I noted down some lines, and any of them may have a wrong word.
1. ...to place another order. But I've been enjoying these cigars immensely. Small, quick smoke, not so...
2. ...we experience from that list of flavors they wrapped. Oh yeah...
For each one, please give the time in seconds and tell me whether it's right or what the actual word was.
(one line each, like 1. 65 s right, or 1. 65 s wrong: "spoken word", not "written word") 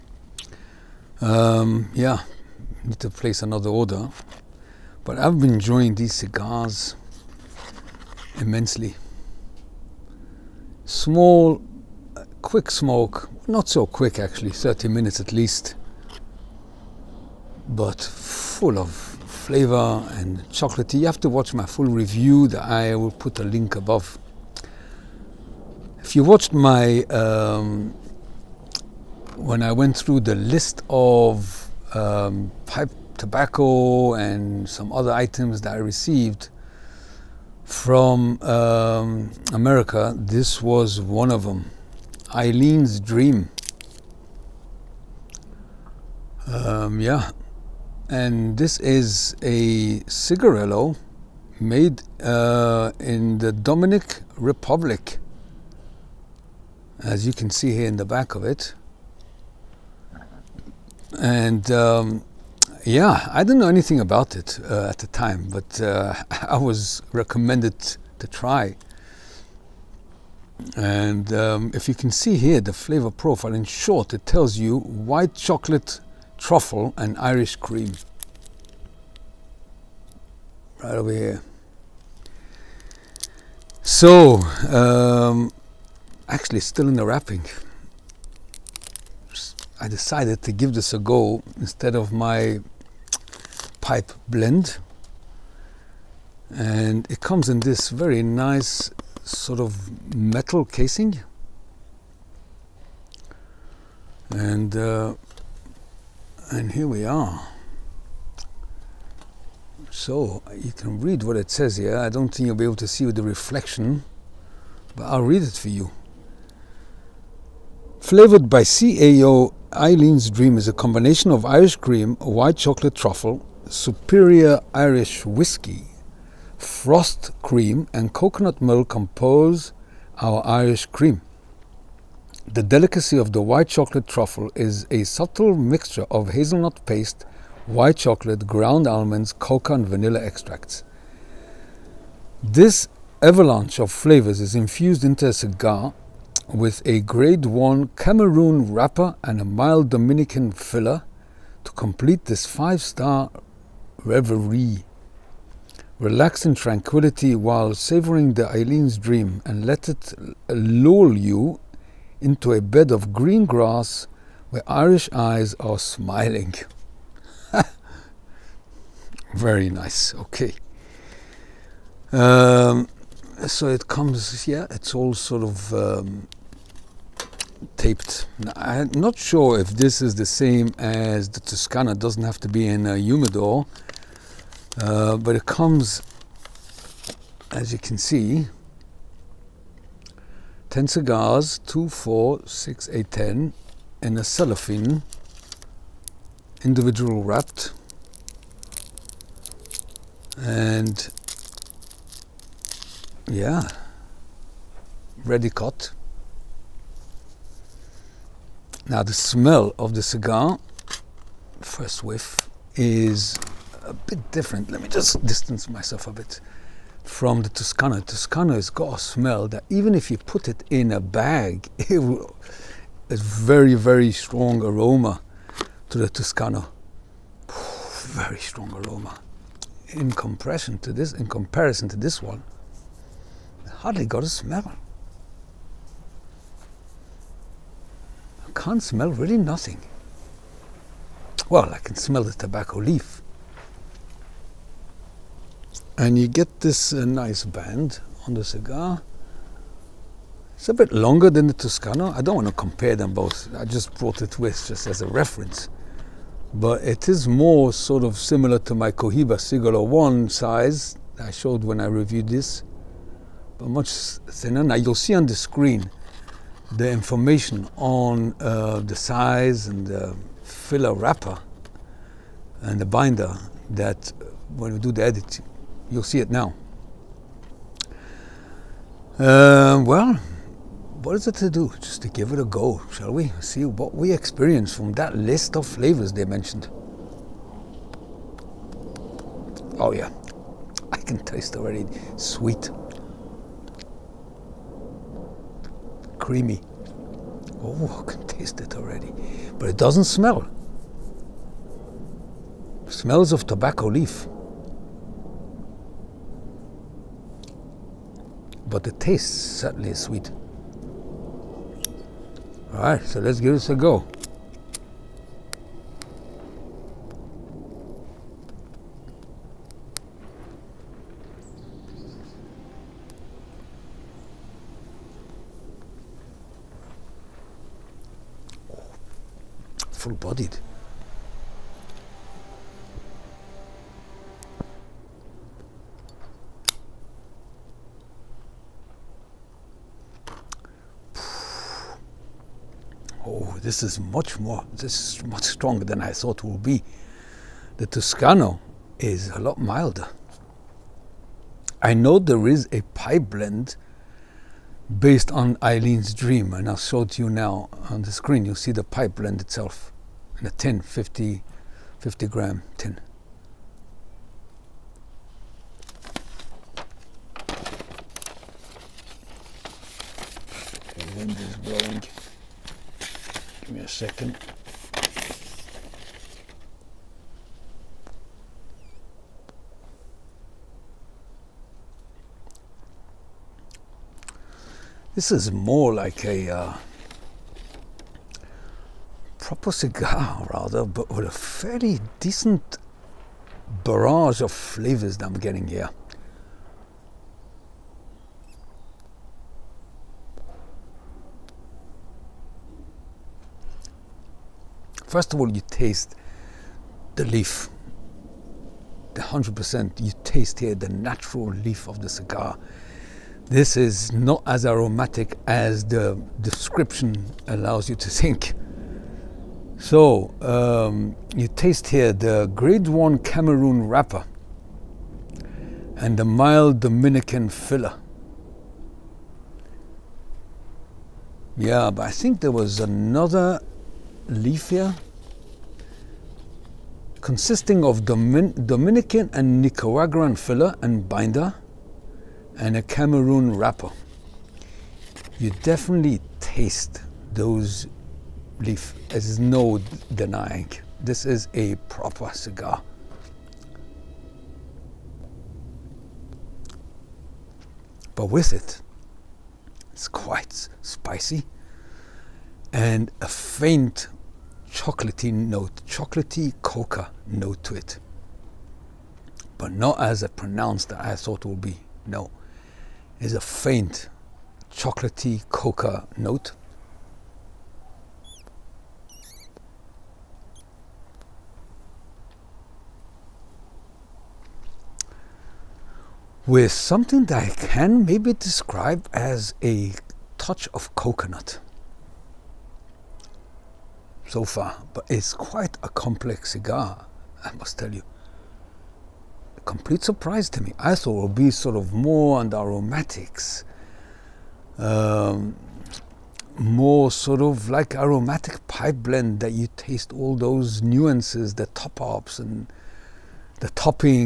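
1. 2 s right
2. 283 s wrong: "mentioned", not "wrapped".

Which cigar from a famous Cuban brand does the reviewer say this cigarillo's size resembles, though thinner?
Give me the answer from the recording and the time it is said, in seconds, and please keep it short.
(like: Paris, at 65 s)
Cohiba Siglo 1, at 258 s.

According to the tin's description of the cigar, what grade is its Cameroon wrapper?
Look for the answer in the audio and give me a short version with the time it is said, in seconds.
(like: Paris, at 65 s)
Grade 1, at 146 s.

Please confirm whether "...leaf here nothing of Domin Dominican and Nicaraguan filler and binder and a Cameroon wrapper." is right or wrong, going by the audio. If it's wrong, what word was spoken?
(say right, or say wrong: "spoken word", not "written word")
wrong: "consisting", not "nothing".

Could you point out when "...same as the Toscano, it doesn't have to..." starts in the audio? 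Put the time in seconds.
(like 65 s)
180 s.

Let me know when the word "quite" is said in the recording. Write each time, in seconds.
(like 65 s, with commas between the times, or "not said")
460 s, 495 s.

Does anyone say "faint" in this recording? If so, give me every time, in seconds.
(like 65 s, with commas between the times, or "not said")
463 s, 473 s.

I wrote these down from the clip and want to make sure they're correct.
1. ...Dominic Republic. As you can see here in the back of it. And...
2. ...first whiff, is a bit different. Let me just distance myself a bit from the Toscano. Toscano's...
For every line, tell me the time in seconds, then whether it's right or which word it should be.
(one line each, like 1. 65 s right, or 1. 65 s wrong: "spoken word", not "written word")
1. 53 s right
2. 211 s right.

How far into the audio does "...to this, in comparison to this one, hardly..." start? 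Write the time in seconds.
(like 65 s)
230 s.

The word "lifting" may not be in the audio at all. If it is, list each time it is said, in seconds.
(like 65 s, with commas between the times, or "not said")
not said.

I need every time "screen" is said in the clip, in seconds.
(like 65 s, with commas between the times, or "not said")
265 s, 358 s.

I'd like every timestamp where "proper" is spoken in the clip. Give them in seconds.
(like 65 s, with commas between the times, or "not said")
389 s, 451 s.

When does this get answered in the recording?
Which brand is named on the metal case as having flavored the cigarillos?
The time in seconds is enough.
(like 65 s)
118 s.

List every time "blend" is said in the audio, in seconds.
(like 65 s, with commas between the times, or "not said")
94 s, 353 s, 359 s, 509 s.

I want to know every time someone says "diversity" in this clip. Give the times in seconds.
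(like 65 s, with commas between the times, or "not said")
not said.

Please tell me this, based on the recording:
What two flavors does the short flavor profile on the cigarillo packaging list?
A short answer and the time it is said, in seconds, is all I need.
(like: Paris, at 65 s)
White chocolate truffle and Irish cream, at 74 s.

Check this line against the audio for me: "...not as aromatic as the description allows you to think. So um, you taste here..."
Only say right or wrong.
right.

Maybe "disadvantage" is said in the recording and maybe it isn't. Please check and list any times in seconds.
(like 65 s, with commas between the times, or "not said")
not said.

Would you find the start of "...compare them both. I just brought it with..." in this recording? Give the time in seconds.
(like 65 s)
252 s.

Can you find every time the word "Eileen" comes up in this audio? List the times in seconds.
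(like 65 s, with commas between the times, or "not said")
42 s, 119 s, 158 s, 355 s.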